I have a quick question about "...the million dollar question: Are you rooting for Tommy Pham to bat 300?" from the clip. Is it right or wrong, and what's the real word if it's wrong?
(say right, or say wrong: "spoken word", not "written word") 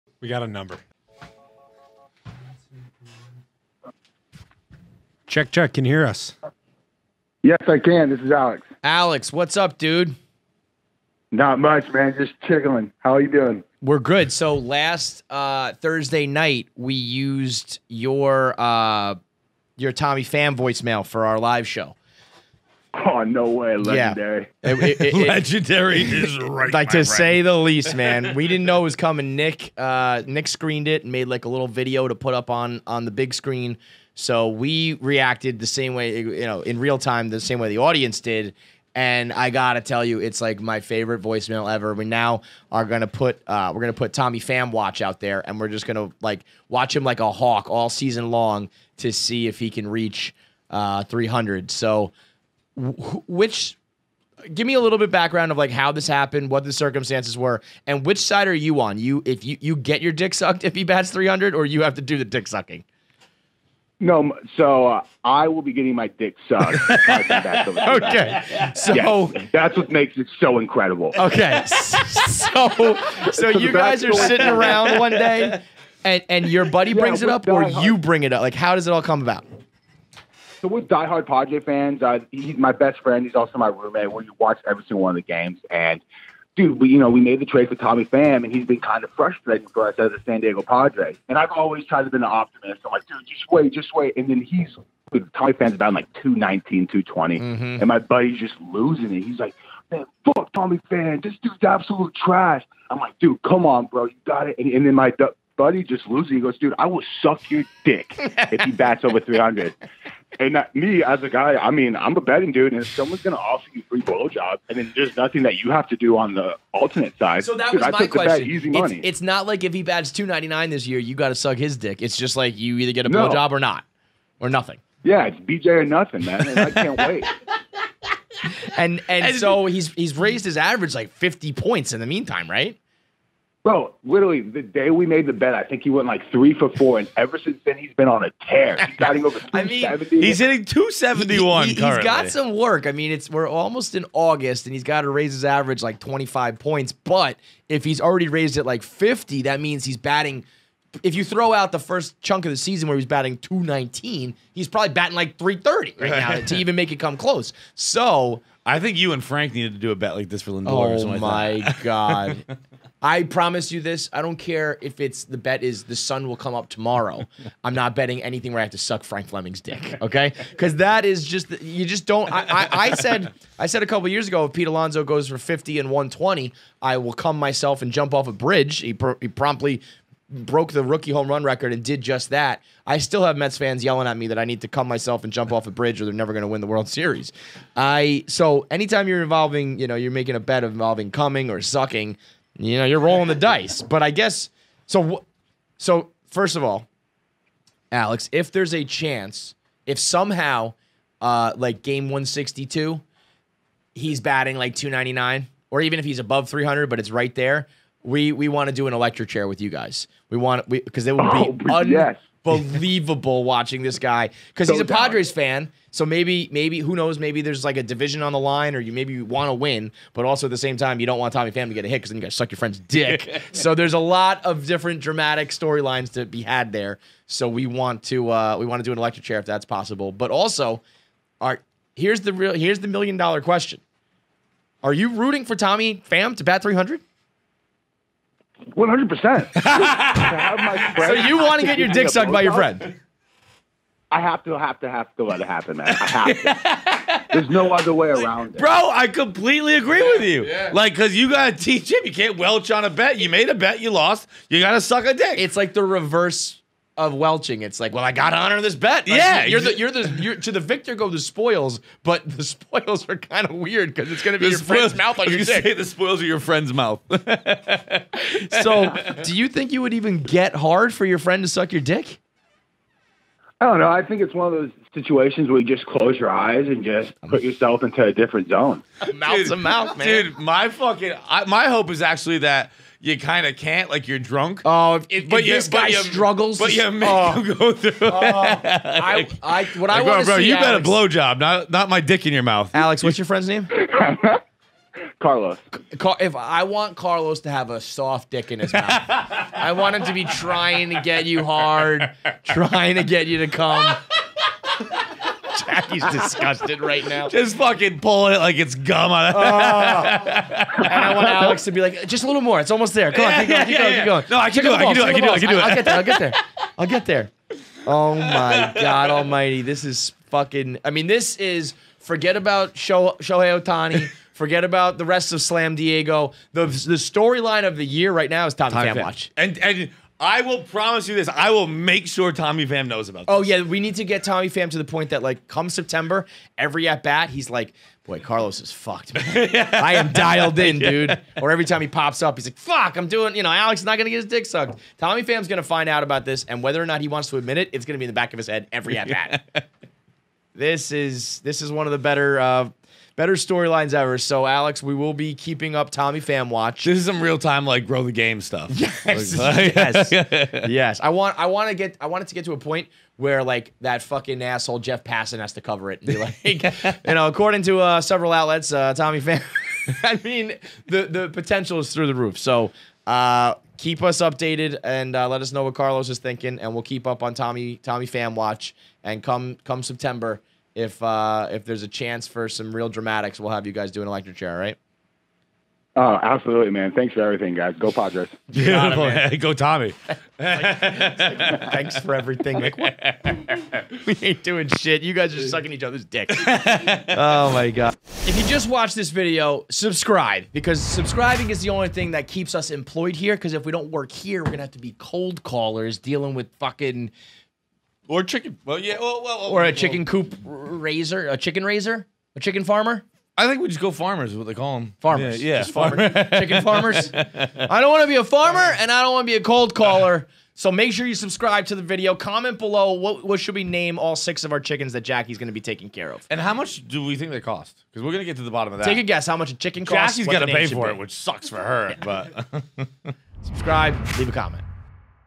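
right.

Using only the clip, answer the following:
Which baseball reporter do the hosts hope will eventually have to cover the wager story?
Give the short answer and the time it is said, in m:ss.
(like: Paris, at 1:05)
Jeff Passan, at 6:04.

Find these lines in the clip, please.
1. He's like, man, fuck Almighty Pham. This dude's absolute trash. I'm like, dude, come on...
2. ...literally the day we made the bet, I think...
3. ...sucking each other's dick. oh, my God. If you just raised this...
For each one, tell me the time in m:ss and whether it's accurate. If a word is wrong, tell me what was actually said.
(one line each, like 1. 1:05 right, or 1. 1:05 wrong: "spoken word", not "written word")
1. 1:39 wrong: "Tommy", not "Almighty"
2. 2:14 right
3. 6:35 wrong: "watched", not "raised".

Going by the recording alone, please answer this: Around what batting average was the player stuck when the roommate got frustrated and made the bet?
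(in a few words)
219.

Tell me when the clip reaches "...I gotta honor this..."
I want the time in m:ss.
4:18.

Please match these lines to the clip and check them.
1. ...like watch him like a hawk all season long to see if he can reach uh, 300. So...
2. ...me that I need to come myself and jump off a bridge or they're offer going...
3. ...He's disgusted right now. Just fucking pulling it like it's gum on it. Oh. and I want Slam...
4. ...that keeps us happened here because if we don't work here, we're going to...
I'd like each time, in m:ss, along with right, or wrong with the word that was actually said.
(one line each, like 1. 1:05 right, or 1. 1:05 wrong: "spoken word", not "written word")
1. 0:46 right
2. 3:04 wrong: "never", not "offer"
3. 5:05 wrong: "Alex", not "Slam"
4. 6:42 wrong: "employed", not "happened".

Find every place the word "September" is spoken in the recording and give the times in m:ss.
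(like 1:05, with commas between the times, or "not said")
5:35, 6:19.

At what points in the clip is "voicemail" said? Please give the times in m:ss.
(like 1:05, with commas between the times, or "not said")
0:20, 0:41.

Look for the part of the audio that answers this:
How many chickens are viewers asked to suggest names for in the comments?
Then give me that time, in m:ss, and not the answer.
7:04.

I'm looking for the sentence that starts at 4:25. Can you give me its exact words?
the spoils are your friend's mouth.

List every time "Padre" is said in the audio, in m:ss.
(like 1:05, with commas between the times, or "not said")
1:21, 1:30, 3:34, 6:27.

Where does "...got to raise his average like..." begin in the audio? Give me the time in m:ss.
2:24.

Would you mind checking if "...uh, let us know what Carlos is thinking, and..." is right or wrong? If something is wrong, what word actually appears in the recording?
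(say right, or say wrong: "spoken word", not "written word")
right.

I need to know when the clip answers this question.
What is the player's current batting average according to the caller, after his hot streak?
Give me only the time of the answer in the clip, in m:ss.
2:20.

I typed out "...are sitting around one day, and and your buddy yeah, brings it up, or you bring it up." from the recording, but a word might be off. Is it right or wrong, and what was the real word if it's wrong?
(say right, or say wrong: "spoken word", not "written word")
right.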